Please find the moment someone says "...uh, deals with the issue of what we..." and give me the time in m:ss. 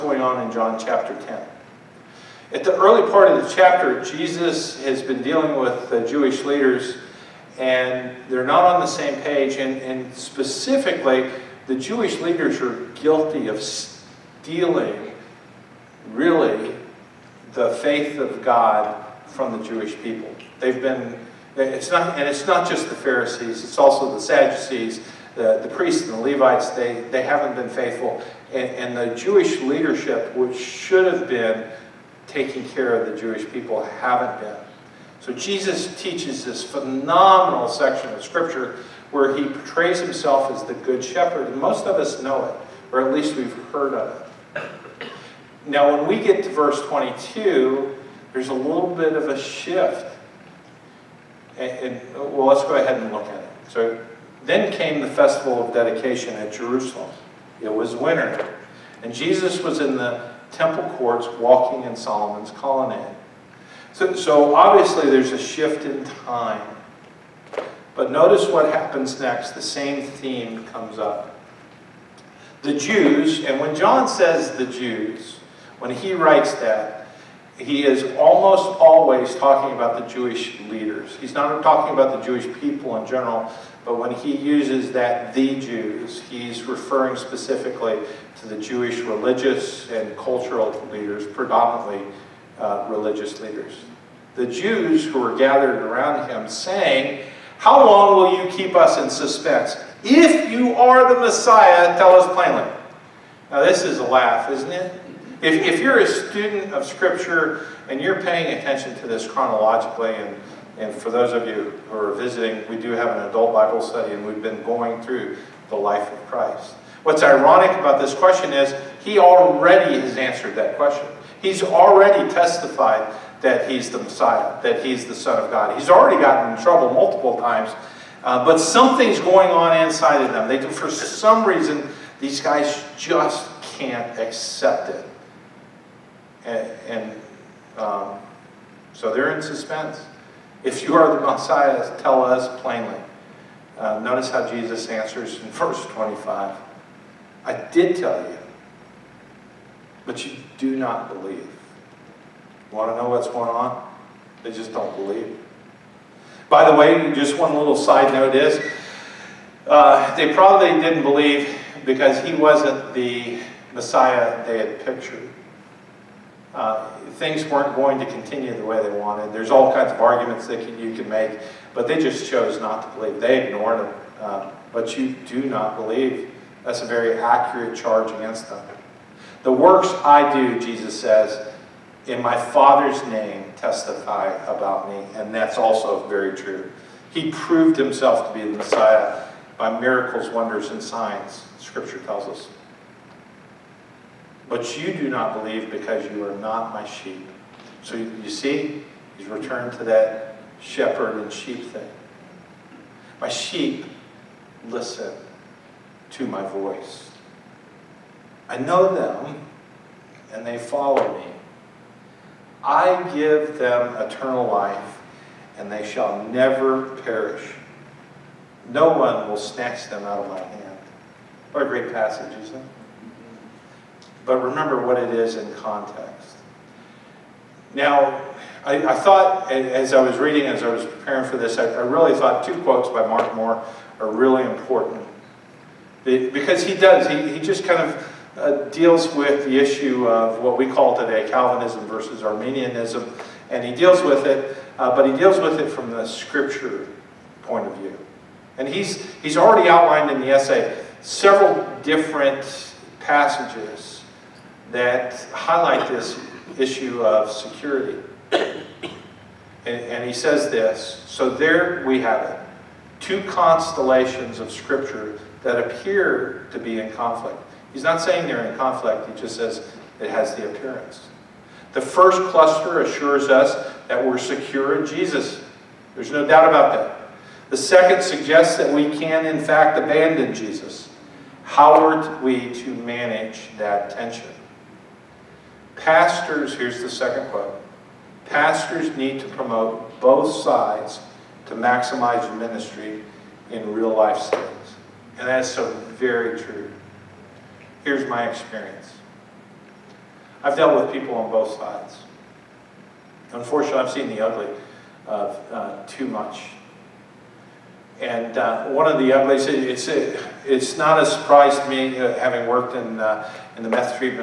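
3:58.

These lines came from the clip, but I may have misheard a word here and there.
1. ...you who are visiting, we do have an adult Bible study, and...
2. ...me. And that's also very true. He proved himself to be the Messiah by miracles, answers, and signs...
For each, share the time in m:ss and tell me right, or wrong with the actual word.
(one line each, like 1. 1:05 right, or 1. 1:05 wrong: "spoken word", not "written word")
1. 1:51 right
2. 3:04 wrong: "wonders", not "answers".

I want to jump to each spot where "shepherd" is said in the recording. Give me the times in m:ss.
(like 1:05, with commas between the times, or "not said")
0:41, 3:20.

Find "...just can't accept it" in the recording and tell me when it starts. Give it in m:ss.
2:12.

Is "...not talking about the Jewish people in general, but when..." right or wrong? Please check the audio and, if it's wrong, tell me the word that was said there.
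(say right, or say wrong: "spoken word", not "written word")
right.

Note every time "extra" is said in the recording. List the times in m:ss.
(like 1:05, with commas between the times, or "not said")
not said.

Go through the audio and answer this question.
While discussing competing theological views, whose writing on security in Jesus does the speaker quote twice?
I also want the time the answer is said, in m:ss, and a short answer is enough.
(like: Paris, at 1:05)
Mark Moore, at 3:53.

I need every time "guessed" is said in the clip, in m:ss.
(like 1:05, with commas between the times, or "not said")
not said.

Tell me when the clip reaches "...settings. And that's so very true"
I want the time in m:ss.
4:54.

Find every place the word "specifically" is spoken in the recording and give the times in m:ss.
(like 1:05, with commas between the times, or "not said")
0:10, 1:27.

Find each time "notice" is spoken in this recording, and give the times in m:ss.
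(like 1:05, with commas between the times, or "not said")
1:08, 2:23.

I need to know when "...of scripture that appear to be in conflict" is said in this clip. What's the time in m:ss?
4:24.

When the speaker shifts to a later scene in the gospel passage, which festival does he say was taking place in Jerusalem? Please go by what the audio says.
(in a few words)
Festival of Dedication.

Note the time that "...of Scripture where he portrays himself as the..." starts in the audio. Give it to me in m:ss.
0:38.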